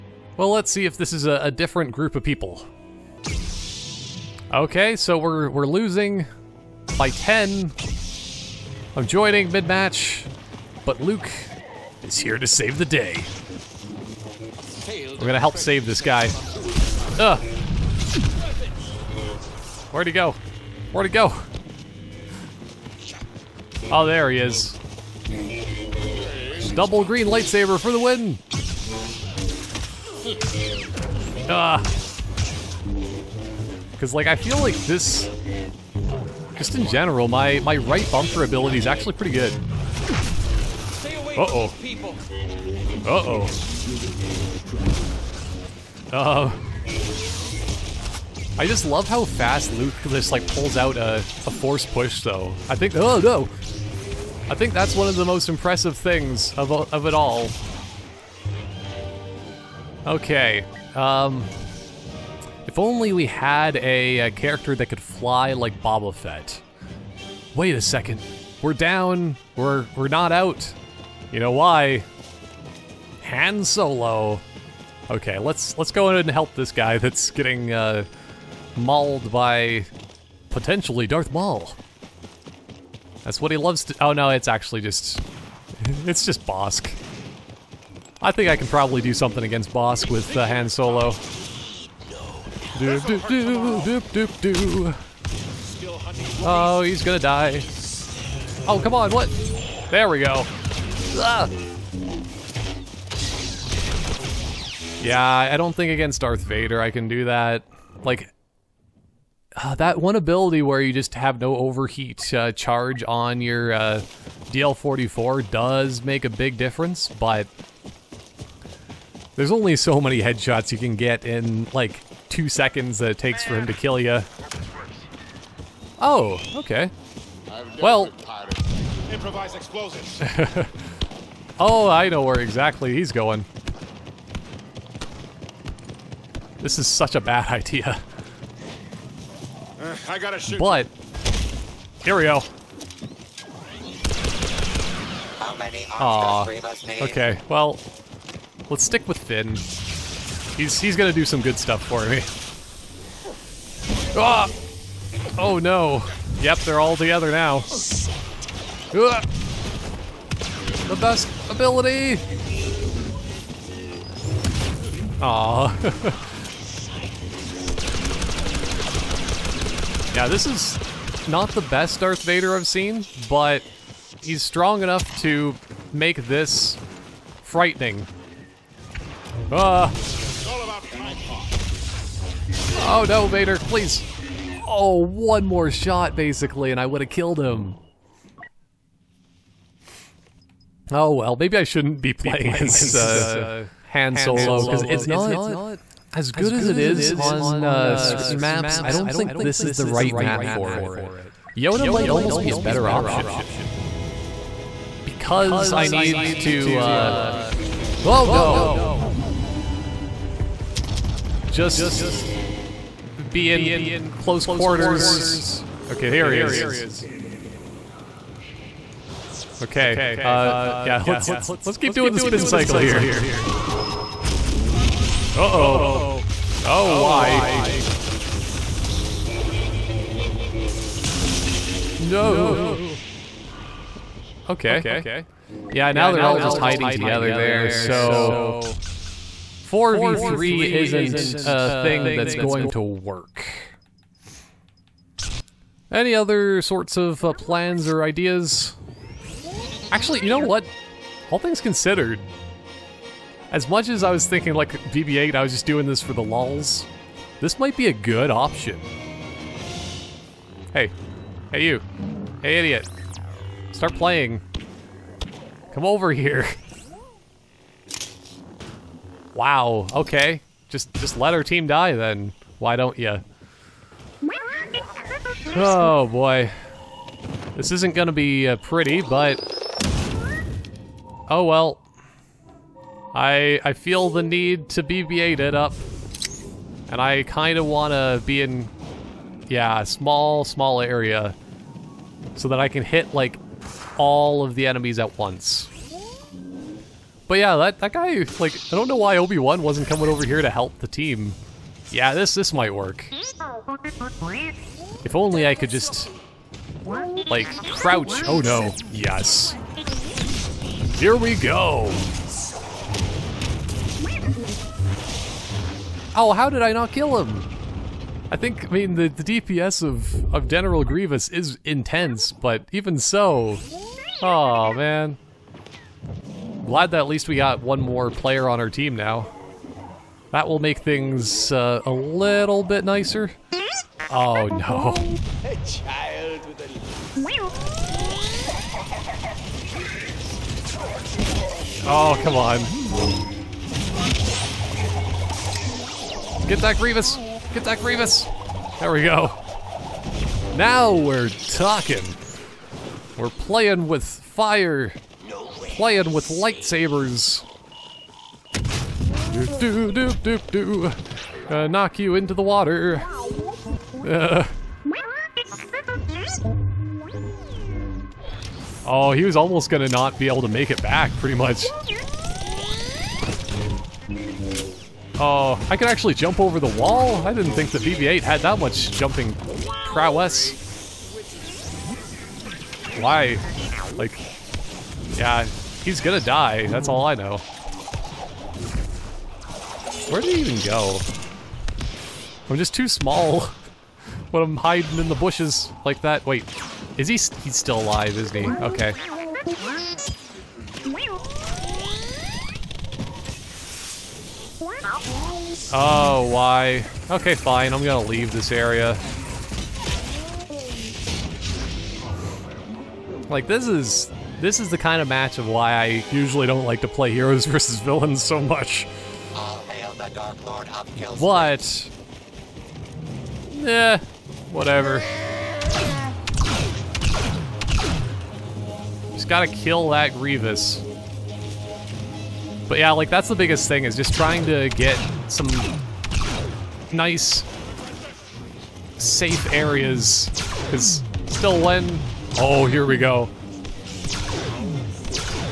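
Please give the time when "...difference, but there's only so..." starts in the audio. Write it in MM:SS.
01:56.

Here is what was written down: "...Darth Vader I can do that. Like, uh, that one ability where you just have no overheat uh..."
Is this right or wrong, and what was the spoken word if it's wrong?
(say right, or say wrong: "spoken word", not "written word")
right.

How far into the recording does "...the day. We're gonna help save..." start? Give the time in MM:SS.
00:12.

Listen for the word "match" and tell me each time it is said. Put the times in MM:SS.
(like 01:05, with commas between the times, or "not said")
00:09, 06:55.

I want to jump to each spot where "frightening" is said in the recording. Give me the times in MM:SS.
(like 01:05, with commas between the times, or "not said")
02:57.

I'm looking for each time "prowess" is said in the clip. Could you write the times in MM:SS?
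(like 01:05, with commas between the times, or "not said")
06:19.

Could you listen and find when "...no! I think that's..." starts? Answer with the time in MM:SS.
00:53.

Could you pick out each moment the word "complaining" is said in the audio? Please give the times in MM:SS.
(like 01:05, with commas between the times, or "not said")
not said.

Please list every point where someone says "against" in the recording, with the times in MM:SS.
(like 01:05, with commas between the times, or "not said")
01:29, 01:45.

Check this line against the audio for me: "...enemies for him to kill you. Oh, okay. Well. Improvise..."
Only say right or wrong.
wrong.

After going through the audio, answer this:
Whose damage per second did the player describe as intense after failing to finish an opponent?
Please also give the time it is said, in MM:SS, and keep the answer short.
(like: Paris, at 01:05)
General Grievous, at 05:20.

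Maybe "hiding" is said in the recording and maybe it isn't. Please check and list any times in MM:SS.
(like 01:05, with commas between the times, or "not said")
03:56, 06:34.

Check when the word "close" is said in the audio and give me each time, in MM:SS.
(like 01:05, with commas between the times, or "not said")
03:34.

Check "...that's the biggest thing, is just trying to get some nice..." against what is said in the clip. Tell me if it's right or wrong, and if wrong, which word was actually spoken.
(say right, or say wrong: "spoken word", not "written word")
right.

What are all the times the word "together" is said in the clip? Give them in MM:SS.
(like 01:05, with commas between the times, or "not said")
02:36, 03:56.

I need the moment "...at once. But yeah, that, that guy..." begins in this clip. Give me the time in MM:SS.
04:54.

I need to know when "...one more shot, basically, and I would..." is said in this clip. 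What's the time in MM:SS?
03:04.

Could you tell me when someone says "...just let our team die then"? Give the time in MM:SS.
04:30.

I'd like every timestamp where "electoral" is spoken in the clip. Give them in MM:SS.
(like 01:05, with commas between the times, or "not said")
not said.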